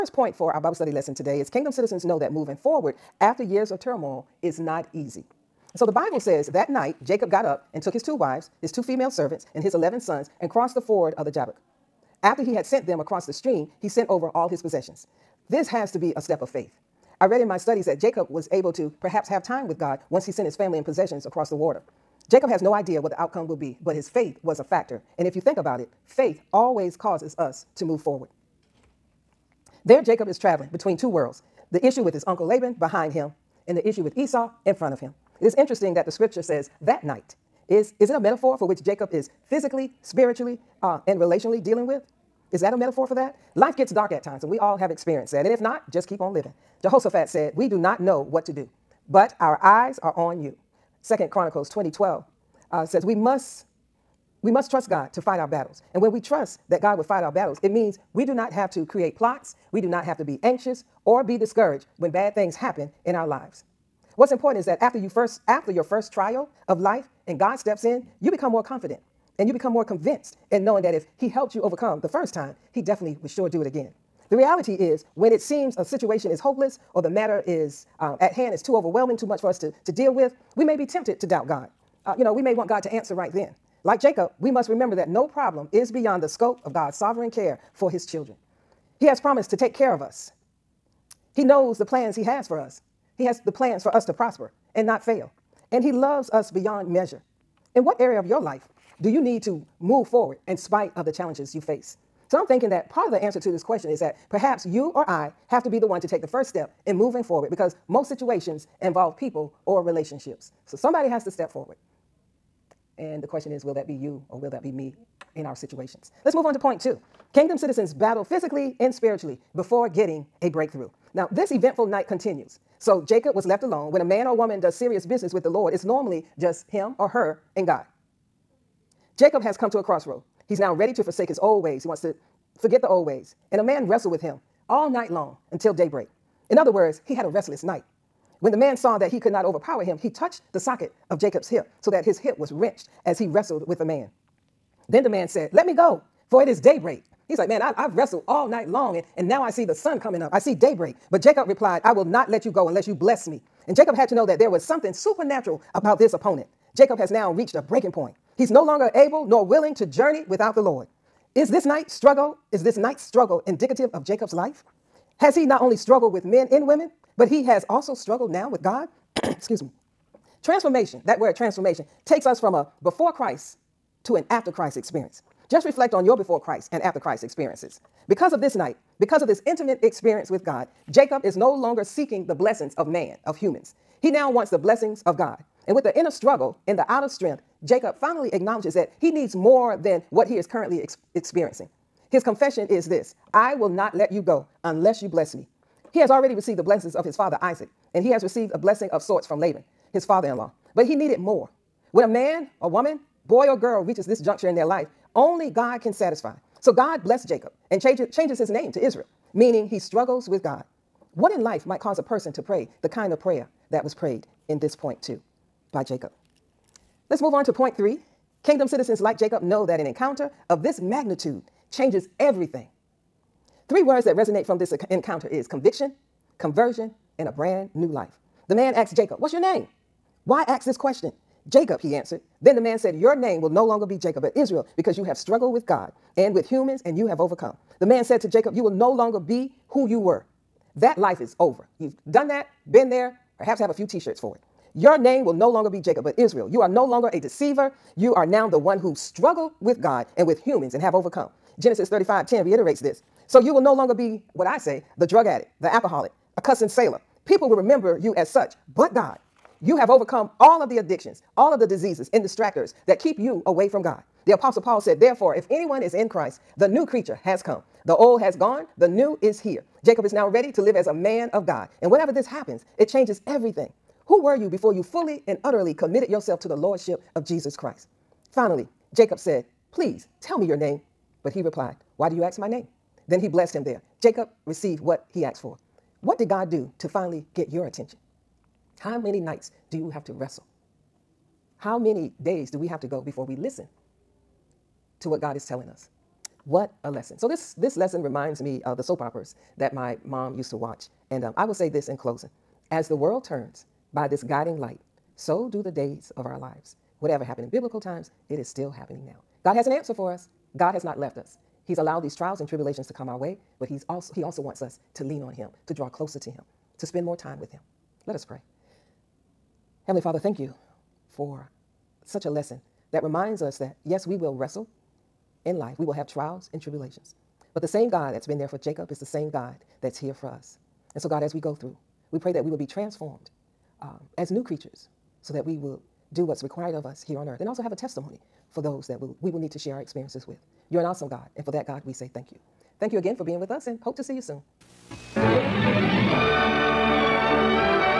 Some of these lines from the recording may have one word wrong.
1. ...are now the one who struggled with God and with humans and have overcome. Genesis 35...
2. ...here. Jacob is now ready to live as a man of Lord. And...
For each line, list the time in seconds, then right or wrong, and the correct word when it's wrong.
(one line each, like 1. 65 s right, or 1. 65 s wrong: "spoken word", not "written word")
1. 248 s right
2. 269 s wrong: "God", not "Lord".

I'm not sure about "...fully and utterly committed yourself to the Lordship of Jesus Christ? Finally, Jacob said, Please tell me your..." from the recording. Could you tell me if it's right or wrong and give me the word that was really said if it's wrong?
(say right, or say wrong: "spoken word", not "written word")
right.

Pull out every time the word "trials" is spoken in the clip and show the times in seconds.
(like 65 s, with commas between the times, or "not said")
66 s, 312 s, 326 s.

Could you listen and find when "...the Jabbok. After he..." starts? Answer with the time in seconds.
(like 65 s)
11 s.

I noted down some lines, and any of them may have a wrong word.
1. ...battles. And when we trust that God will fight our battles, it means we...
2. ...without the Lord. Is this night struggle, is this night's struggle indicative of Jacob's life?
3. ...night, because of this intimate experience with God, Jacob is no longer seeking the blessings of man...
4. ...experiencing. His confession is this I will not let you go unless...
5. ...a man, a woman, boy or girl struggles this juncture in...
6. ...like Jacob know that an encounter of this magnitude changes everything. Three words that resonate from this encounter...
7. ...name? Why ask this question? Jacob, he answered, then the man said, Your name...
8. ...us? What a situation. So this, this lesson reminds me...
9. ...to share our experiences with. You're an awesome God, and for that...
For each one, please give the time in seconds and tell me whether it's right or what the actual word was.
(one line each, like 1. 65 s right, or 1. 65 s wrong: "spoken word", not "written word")
1. 55 s right
2. 160 s right
3. 178 s right
4. 191 s right
5. 202 s wrong: "reaches", not "struggles"
6. 218 s right
7. 229 s right
8. 295 s wrong: "lesson", not "situation"
9. 339 s right.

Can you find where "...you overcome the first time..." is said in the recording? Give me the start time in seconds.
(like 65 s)
71 s.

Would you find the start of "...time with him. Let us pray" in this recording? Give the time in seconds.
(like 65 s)
317 s.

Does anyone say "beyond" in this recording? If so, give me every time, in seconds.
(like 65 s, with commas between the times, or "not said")
85 s, 96 s.